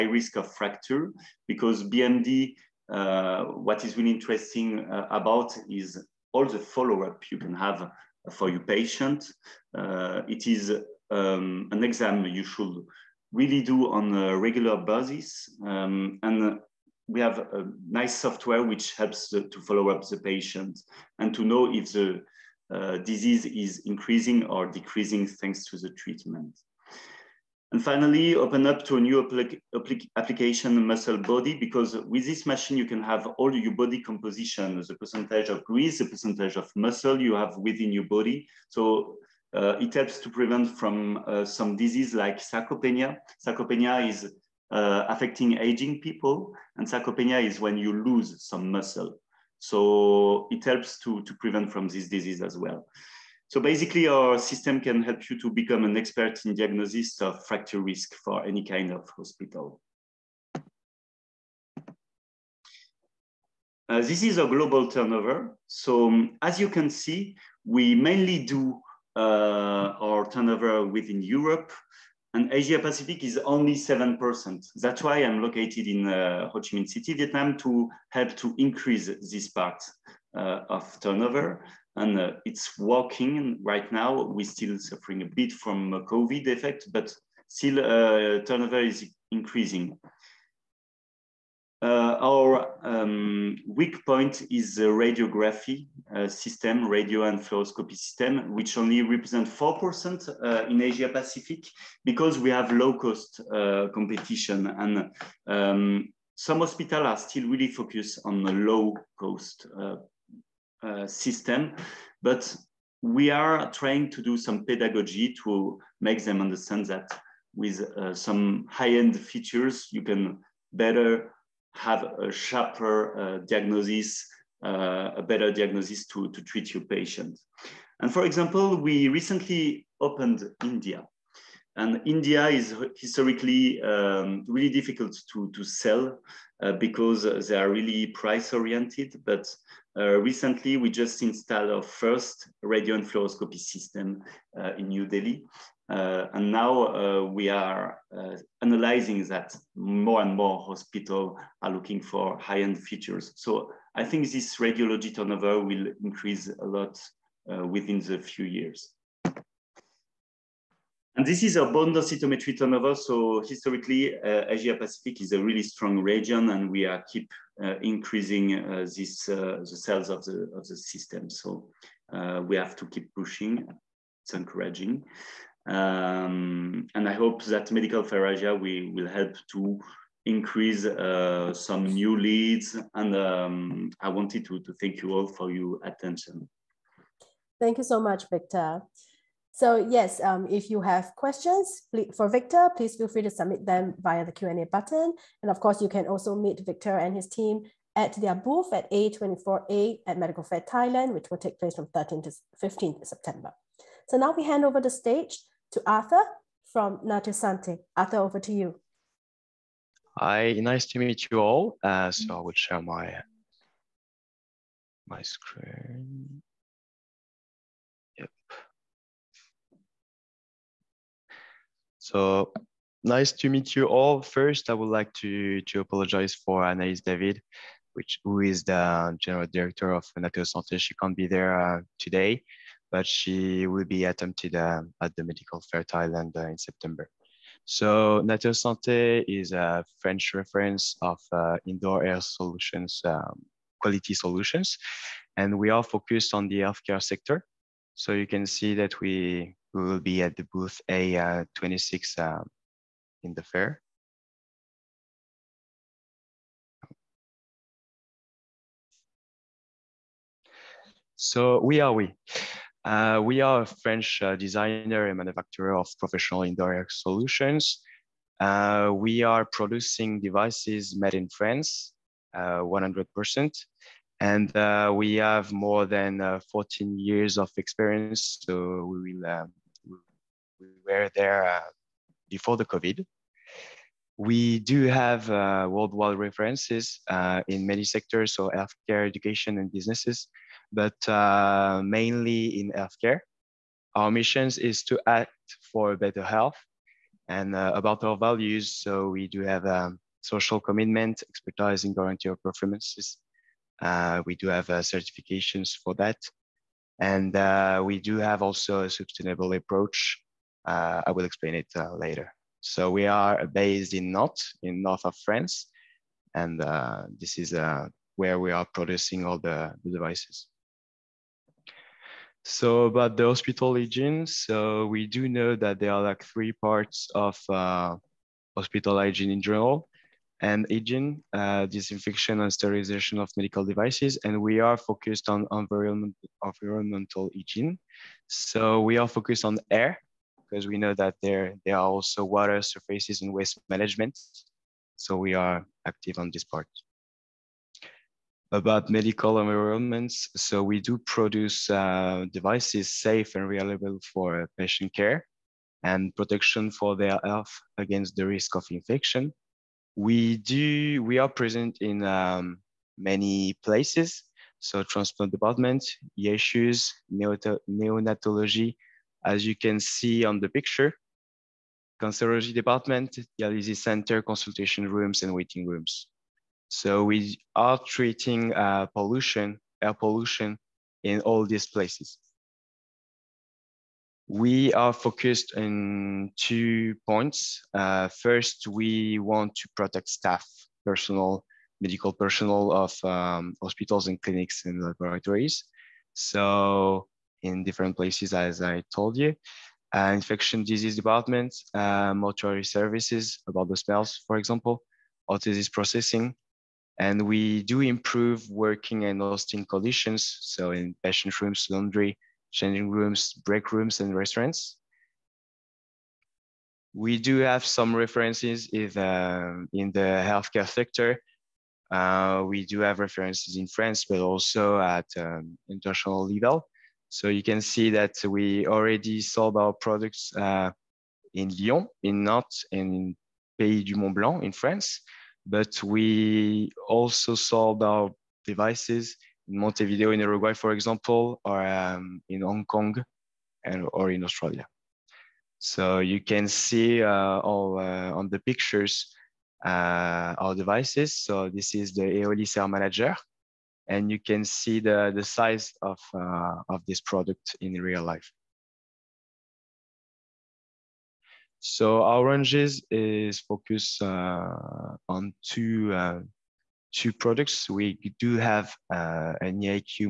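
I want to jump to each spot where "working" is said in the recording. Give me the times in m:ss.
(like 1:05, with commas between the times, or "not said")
1:22, 6:48.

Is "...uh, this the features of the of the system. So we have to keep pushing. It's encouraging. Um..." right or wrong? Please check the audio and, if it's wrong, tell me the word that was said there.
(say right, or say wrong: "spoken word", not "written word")
wrong: "sales", not "features".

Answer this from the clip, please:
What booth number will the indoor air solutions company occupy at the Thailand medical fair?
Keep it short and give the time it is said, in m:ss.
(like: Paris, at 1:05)
A26, at 4:10.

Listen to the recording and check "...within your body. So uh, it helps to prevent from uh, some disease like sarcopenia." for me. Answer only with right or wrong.
right.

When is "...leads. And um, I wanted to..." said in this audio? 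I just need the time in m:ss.
3:02.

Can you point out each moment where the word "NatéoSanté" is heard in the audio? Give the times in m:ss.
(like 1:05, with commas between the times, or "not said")
3:26, 3:50, 3:58.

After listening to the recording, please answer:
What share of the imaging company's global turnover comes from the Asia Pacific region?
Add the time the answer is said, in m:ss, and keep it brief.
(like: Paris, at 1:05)
7%, at 1:13.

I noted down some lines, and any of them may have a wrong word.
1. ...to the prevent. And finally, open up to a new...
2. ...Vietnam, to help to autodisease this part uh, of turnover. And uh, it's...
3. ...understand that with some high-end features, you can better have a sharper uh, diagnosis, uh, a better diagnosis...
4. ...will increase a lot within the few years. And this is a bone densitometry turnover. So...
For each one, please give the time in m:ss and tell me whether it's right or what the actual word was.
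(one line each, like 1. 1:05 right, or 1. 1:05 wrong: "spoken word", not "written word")
1. 0:25 wrong: "treatment", not "prevent"
2. 1:17 wrong: "increase", not "autodisease"
3. 1:56 right
4. 2:35 right.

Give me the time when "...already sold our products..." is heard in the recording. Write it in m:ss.
7:08.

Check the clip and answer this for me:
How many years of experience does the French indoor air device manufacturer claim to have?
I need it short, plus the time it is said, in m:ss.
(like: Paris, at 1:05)
14 years, at 4:36.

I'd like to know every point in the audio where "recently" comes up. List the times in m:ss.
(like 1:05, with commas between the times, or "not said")
2:09, 2:20.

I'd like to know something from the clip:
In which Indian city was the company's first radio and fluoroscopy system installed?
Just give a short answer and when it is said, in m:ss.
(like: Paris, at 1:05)
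New Delhi, at 2:24.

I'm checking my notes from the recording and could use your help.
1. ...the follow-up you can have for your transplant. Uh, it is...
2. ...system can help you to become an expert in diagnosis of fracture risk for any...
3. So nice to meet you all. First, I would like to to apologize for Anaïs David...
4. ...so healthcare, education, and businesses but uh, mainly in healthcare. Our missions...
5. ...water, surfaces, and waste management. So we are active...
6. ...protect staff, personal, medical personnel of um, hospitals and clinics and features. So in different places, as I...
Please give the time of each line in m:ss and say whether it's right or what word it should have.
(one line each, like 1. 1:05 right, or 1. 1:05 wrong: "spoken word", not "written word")
1. 0:06 wrong: "patient", not "transplant"
2. 0:54 right
3. 3:41 right
4. 4:48 right
5. 5:42 right
6. 6:29 wrong: "laboratories", not "features".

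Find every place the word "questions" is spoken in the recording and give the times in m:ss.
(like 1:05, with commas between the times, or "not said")
3:11.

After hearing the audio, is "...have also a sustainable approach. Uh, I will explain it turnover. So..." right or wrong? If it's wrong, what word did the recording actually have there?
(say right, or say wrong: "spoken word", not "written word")
wrong: "later", not "turnover".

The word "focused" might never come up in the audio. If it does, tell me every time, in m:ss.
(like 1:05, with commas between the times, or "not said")
1:47, 4:05, 5:34, 5:39, 6:24, 7:43.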